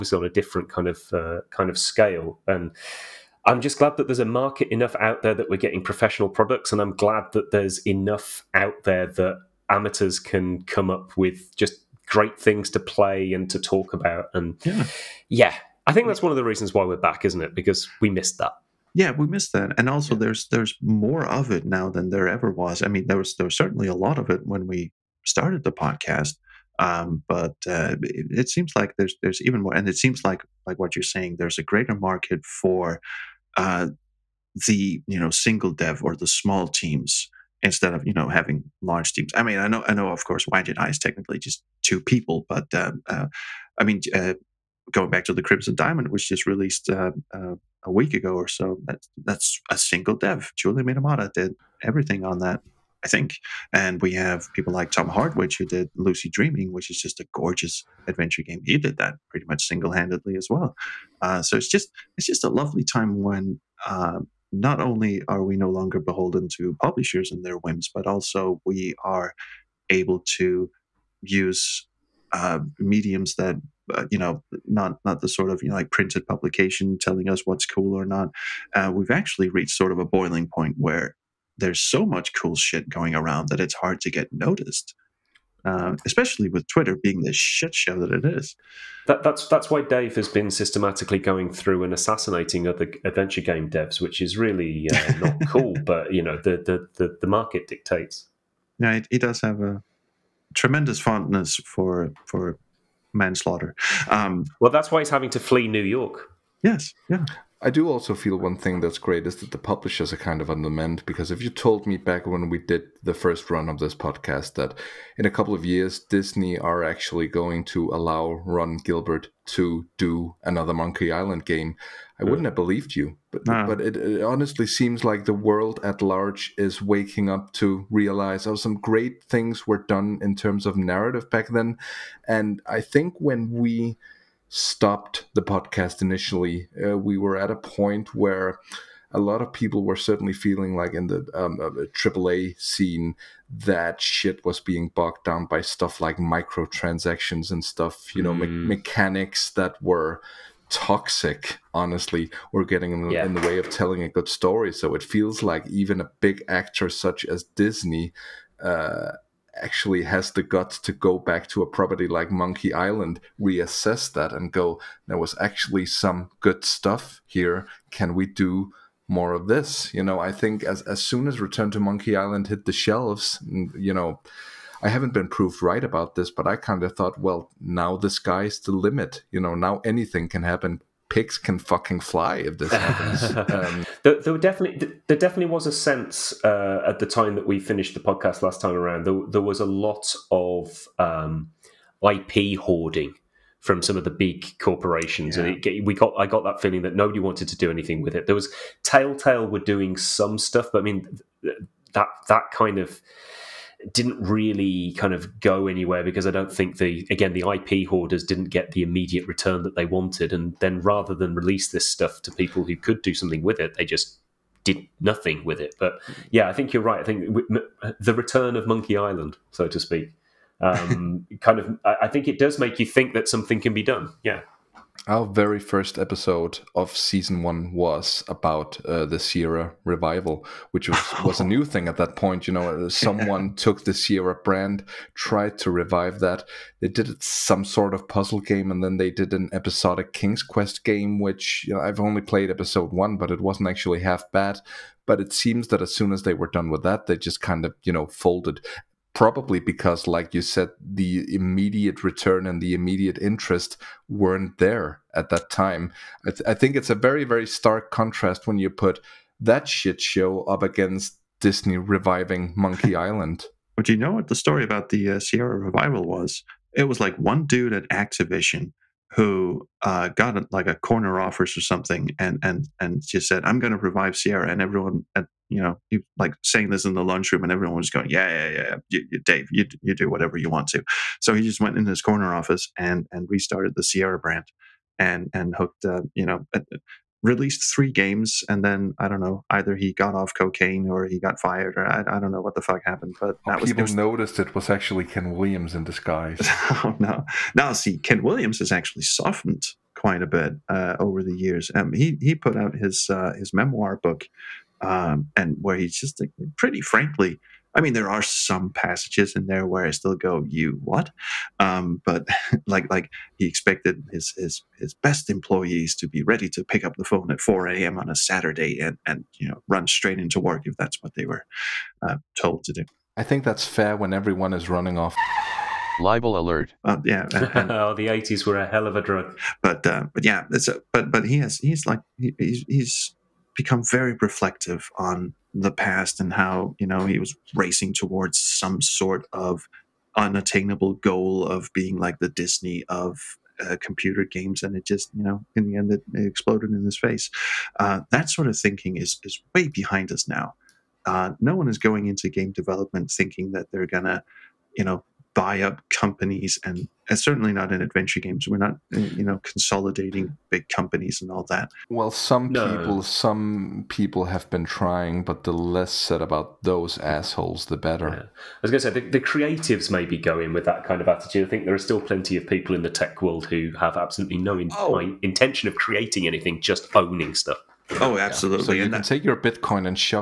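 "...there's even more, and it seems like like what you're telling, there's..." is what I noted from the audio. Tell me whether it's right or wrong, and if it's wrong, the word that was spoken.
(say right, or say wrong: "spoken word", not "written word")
wrong: "saying", not "telling".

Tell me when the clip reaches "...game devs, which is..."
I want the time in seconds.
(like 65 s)
93 s.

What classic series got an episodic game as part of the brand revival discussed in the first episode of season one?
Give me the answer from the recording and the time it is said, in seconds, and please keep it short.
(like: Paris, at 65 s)
King's Quest, at 240 s.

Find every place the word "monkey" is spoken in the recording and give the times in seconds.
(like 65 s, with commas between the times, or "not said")
120 s, 162 s, 171 s, 218 s, 262 s.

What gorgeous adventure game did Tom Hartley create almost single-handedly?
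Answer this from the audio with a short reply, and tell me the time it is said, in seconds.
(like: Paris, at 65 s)
Lucy Dreaming, at 55 s.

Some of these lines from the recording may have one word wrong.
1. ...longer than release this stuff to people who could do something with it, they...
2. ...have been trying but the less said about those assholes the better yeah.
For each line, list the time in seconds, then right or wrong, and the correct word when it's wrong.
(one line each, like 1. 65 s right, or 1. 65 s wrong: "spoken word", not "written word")
1. 210 s wrong: "rather", not "longer"
2. 364 s right.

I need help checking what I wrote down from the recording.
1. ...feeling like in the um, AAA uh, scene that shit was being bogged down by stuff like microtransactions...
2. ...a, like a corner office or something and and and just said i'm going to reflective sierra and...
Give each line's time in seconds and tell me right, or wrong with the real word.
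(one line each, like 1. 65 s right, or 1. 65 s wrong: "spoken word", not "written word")
1. 140 s right
2. 270 s wrong: "revive", not "reflective".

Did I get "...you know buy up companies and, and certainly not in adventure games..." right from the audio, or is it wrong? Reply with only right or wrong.
right.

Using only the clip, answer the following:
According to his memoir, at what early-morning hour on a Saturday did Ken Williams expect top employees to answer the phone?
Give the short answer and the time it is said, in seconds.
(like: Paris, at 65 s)
4 a.m., at 317 s.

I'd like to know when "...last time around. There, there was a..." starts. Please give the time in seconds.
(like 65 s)
188 s.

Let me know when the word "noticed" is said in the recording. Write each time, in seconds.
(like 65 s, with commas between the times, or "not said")
84 s, 293 s.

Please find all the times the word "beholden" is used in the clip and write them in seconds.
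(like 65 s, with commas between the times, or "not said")
65 s.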